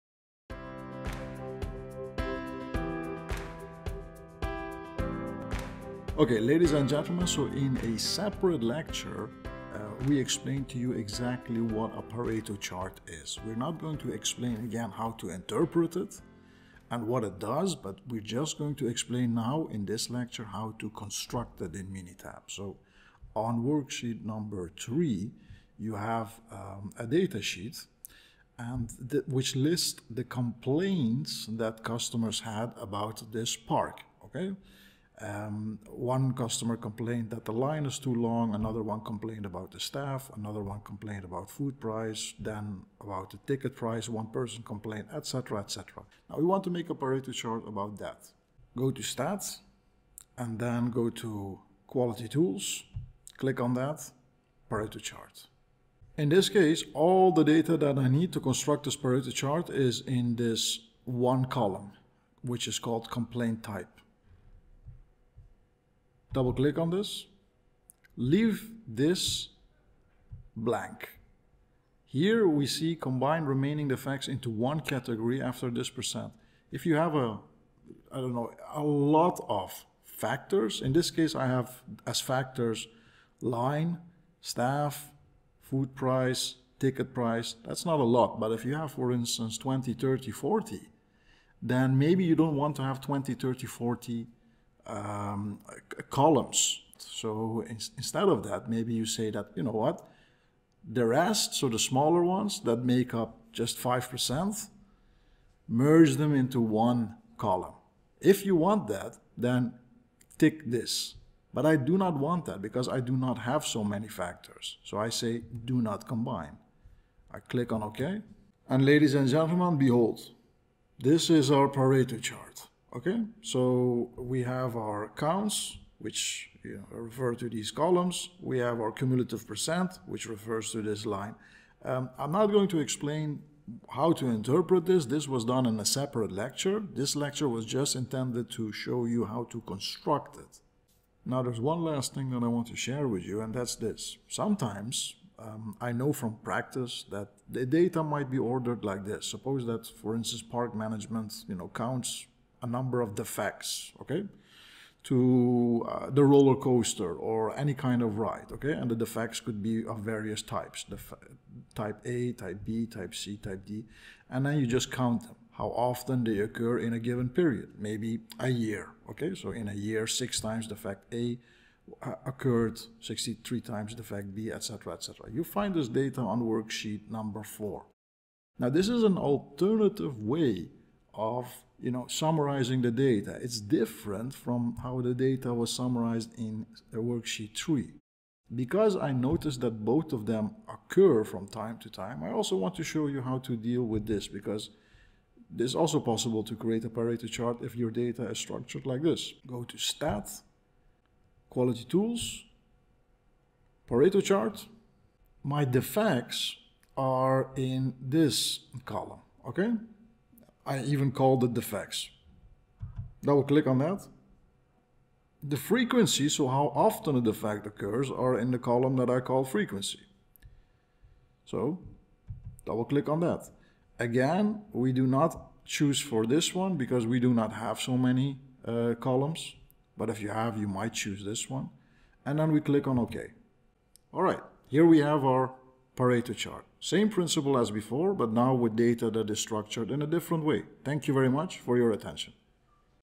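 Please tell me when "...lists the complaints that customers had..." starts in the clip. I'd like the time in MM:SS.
00:29.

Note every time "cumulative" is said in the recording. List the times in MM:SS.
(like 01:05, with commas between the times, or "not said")
02:08.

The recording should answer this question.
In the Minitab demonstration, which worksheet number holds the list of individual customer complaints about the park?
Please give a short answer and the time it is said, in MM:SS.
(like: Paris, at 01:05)
3, at 00:23.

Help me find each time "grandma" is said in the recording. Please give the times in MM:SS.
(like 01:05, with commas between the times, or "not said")
not said.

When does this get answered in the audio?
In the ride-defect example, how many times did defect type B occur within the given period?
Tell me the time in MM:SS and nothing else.
02:53.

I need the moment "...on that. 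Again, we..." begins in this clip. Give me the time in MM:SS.
03:43.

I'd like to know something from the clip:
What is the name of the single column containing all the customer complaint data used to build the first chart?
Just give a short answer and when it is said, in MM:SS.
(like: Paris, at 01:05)
complaint type, at 01:03.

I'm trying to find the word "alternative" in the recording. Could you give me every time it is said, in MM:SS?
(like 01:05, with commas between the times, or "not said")
02:59.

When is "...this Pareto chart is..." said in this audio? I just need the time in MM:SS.
00:58.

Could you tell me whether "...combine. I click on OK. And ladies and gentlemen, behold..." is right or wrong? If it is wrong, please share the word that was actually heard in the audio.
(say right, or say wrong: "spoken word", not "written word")
right.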